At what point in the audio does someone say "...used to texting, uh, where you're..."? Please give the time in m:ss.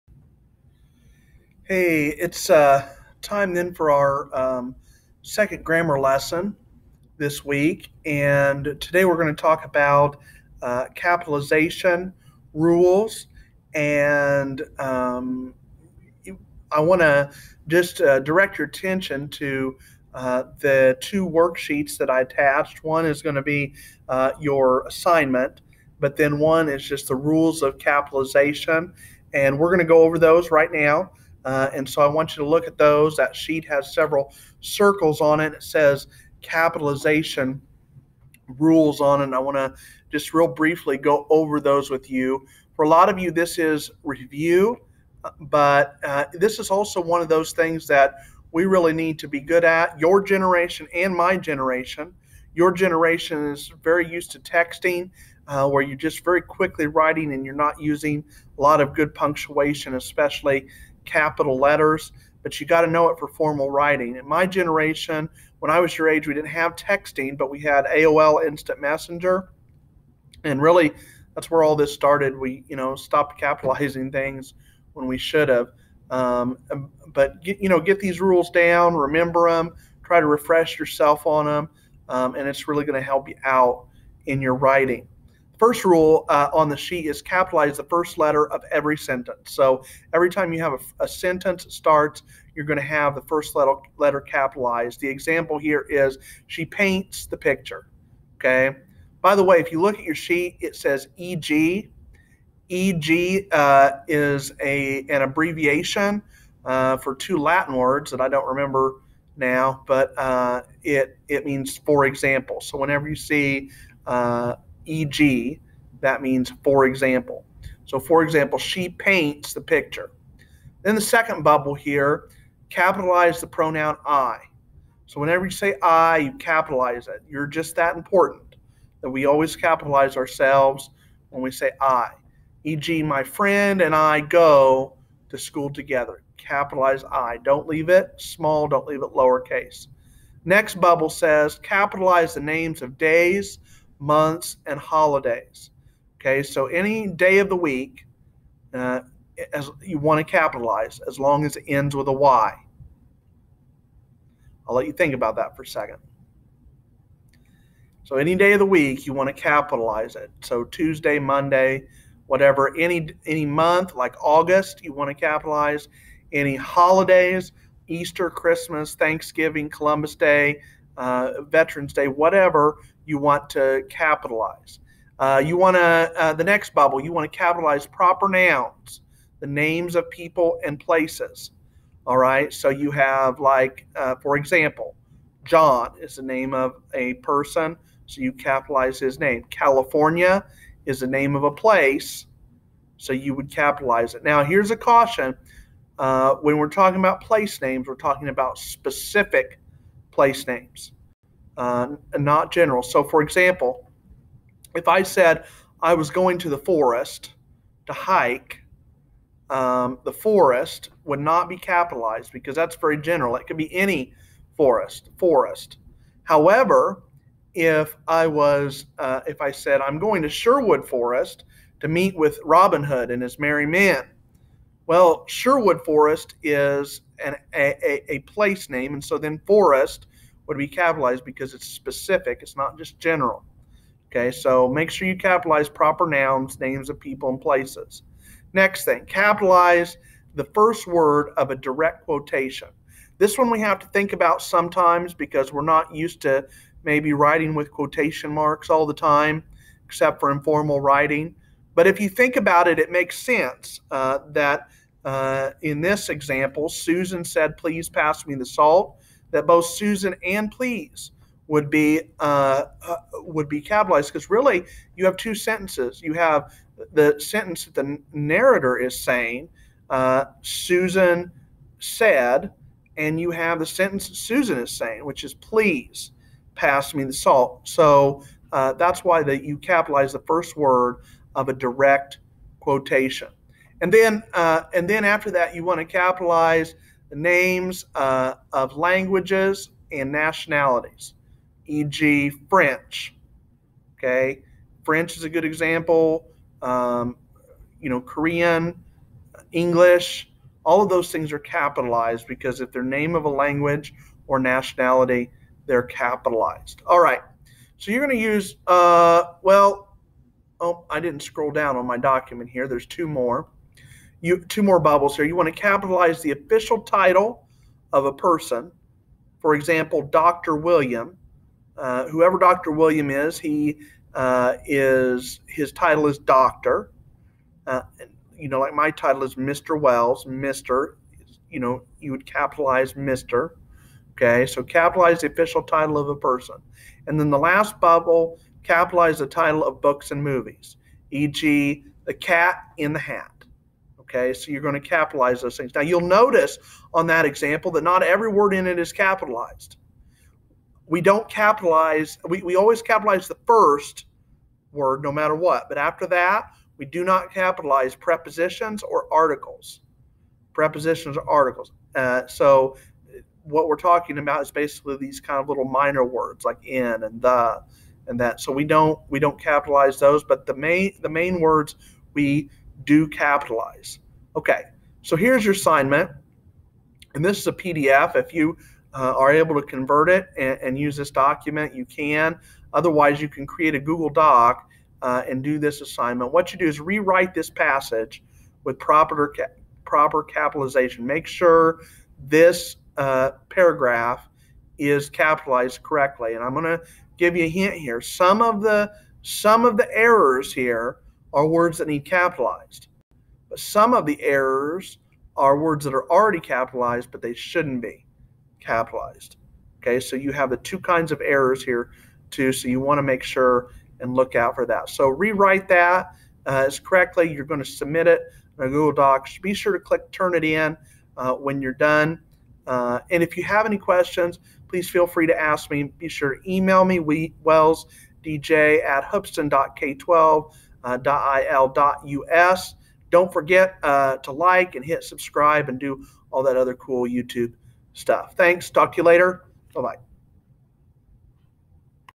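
0:54.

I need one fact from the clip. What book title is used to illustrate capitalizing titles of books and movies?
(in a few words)
The Cat in the Hat.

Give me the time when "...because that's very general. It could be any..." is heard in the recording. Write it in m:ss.
3:32.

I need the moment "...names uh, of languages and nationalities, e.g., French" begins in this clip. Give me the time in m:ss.
4:47.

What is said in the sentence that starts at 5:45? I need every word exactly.
Now you'll notice on that example that not every word in it is capitalized.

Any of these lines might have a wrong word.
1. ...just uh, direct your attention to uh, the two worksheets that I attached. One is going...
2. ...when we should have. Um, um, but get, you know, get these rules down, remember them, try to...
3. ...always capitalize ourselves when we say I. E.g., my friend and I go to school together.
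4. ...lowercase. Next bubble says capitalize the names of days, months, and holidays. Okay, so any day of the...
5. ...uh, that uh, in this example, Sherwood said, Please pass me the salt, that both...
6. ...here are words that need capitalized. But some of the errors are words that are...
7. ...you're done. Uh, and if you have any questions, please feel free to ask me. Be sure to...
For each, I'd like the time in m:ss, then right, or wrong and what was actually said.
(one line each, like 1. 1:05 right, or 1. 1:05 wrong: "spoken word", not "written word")
1. 0:17 right
2. 1:14 right
3. 2:09 right
4. 2:19 right
5. 4:13 wrong: "Susan", not "Sherwood"
6. 6:40 right
7. 7:01 right.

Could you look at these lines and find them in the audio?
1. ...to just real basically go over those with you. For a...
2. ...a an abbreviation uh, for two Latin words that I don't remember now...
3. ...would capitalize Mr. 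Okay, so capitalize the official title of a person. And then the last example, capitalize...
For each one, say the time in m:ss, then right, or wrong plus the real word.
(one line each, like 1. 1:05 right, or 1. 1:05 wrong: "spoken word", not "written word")
1. 0:39 wrong: "briefly", not "basically"
2. 1:44 right
3. 5:32 wrong: "bubble", not "example".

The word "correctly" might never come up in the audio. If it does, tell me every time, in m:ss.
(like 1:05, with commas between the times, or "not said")
6:35, 6:56.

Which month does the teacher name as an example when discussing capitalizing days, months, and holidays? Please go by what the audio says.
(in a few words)
August.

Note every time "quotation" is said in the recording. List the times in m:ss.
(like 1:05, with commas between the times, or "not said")
4:02, 4:07, 4:42.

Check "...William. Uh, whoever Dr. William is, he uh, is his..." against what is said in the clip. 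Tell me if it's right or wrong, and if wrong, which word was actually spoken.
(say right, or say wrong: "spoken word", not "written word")
right.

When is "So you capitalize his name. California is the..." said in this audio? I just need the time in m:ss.
3:08.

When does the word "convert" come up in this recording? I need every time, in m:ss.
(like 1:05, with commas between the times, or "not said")
6:19.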